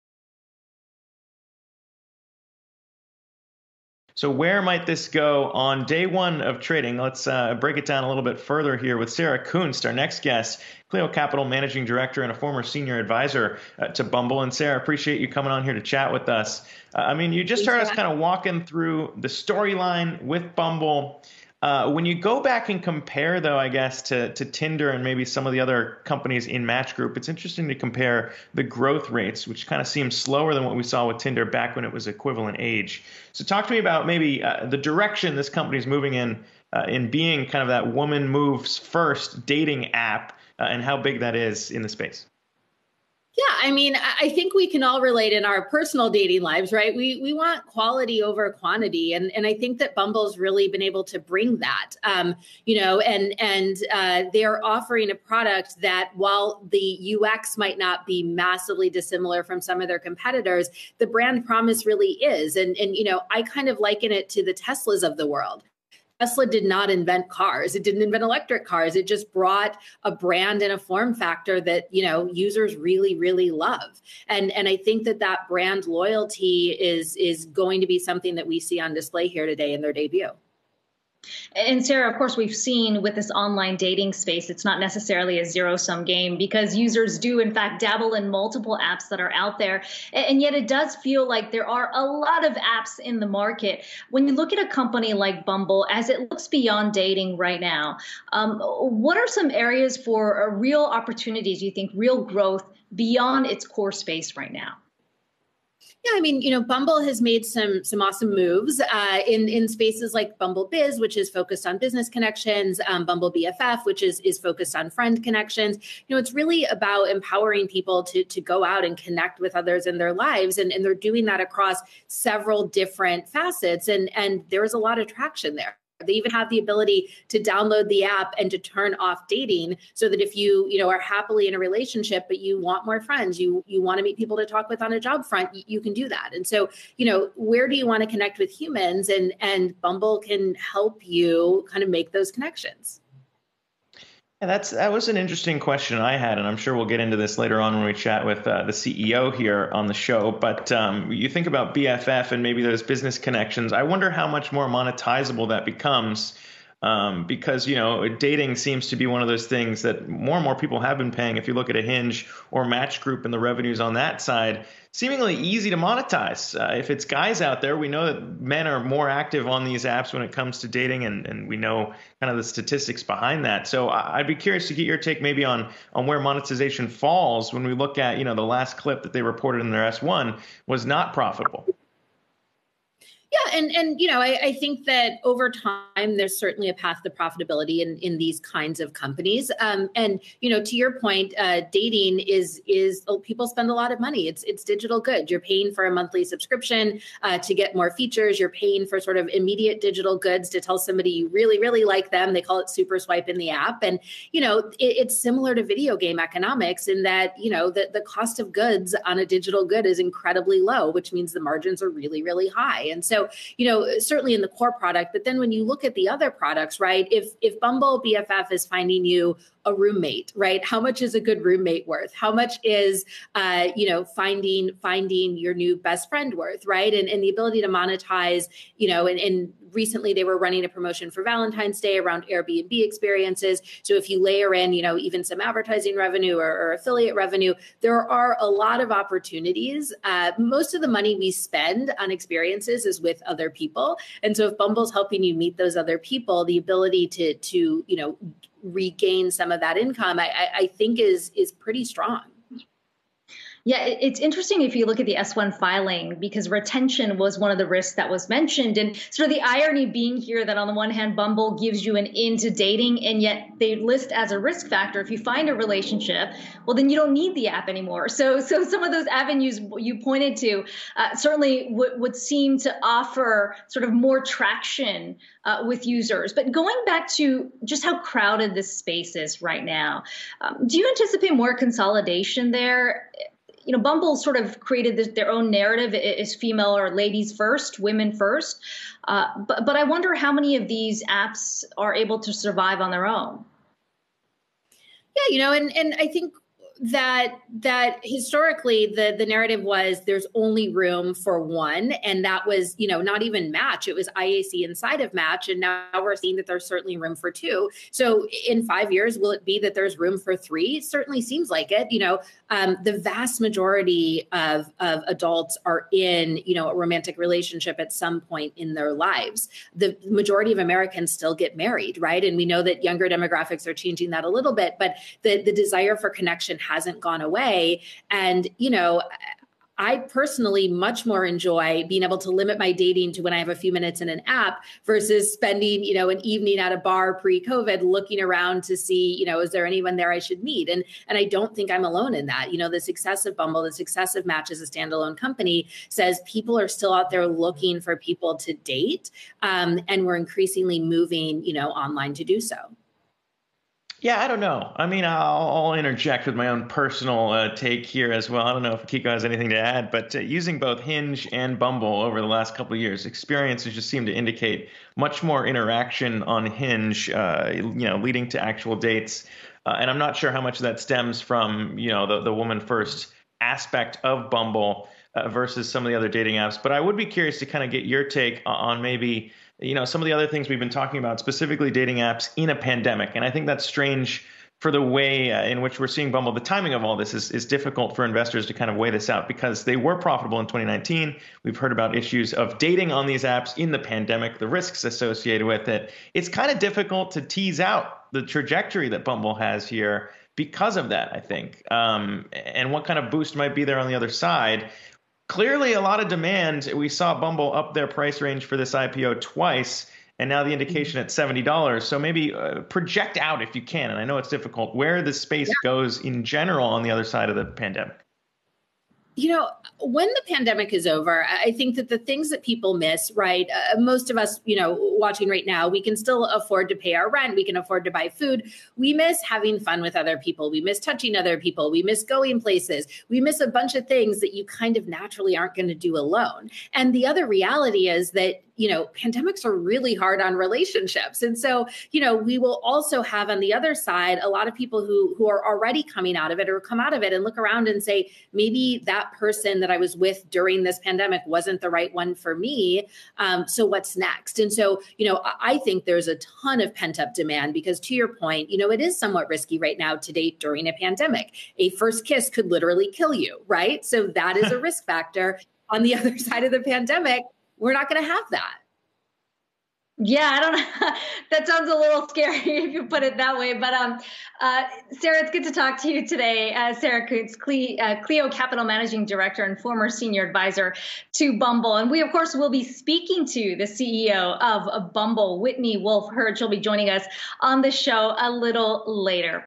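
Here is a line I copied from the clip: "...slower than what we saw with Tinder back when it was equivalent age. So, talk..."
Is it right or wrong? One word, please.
right.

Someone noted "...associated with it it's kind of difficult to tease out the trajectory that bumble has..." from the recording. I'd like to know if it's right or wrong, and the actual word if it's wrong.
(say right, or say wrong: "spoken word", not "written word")
right.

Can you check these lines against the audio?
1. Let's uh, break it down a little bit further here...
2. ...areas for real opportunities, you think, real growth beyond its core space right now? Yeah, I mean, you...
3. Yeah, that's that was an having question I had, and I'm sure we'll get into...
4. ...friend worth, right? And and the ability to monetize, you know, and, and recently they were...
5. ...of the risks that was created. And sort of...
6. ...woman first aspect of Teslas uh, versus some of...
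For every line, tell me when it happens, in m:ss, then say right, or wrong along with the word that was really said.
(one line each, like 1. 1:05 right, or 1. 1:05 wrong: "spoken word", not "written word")
1. 0:06 right
2. 1:39 right
3. 2:24 wrong: "interesting", not "having"
4. 3:46 right
5. 4:17 wrong: "mentioned", not "created"
6. 6:12 wrong: "Bumble", not "Teslas".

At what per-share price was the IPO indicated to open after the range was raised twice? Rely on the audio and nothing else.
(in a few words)
$70.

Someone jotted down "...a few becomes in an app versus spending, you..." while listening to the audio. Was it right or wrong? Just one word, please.
wrong.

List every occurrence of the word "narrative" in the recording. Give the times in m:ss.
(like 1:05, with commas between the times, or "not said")
4:45, 4:59.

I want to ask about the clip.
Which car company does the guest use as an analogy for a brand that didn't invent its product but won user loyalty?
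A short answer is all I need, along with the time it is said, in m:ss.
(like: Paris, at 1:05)
Tesla, at 1:06.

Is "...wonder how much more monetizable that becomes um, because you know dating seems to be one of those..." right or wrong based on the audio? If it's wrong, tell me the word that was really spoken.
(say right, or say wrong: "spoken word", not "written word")
right.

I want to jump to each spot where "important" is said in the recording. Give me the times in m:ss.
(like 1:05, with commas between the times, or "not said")
not said.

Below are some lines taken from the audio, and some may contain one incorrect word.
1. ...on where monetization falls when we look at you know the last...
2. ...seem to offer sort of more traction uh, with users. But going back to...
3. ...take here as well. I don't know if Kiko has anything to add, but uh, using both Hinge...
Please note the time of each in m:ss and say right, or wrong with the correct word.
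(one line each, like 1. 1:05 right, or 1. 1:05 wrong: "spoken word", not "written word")
1. 2:55 right
2. 4:32 right
3. 5:57 right.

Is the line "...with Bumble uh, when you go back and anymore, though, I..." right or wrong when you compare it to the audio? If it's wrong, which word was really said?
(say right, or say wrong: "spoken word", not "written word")
wrong: "compare", not "anymore".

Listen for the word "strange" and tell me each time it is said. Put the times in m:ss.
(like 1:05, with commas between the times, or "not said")
6:23.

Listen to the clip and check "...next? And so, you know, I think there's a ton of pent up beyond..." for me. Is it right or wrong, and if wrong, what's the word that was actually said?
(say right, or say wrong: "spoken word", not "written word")
wrong: "demand", not "beyond".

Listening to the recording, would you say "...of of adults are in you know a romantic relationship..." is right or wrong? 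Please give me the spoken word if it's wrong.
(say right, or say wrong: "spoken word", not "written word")
right.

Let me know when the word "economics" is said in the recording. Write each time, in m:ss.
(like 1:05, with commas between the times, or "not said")
3:26.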